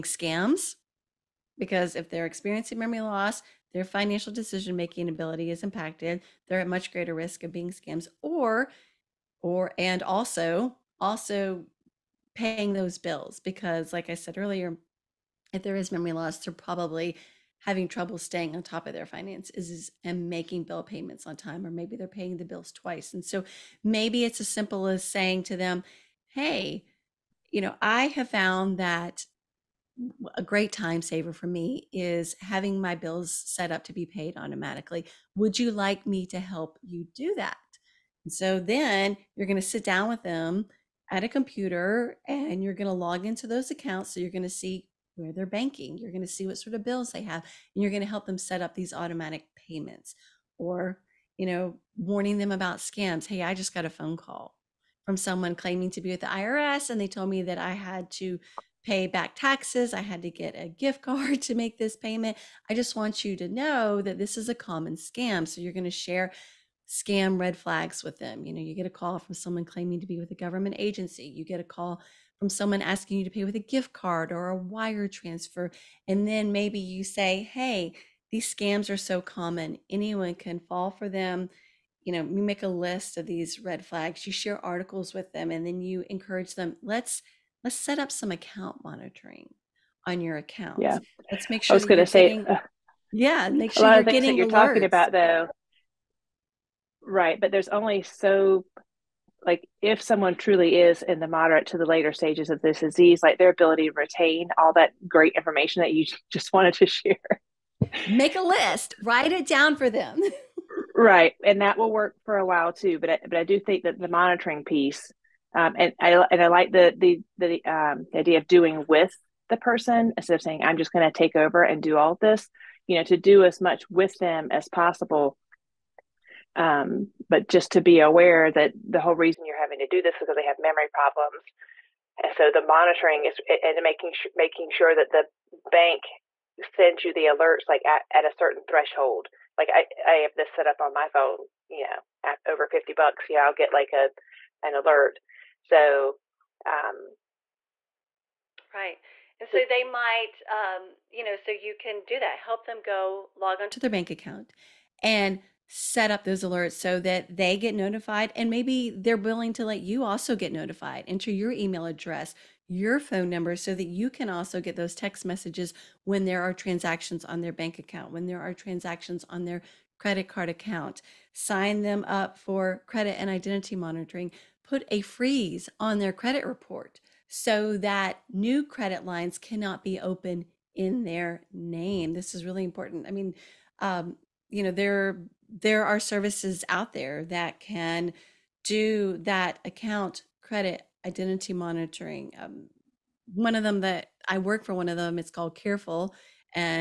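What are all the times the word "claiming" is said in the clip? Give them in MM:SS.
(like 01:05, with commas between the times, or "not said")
00:55, 01:09.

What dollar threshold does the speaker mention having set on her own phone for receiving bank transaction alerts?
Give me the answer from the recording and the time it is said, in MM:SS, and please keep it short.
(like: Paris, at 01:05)
$50, at 02:22.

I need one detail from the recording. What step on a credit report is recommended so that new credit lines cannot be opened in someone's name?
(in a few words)
A freeze.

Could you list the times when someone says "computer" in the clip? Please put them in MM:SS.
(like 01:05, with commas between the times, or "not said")
00:41.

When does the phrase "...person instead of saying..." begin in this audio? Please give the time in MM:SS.
01:59.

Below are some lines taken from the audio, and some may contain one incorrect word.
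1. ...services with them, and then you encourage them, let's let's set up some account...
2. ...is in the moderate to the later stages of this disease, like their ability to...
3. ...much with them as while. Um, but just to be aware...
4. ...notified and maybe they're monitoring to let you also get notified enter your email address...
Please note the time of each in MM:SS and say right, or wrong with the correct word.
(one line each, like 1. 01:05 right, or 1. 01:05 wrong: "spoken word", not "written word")
1. 01:24 wrong: "articles", not "services"
2. 01:40 right
3. 02:03 wrong: "possible", not "while"
4. 02:37 wrong: "willing", not "monitoring".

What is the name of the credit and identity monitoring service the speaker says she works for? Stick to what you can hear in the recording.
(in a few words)
Careful.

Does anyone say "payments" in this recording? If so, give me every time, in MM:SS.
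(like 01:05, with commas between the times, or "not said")
00:20, 00:49, 01:01.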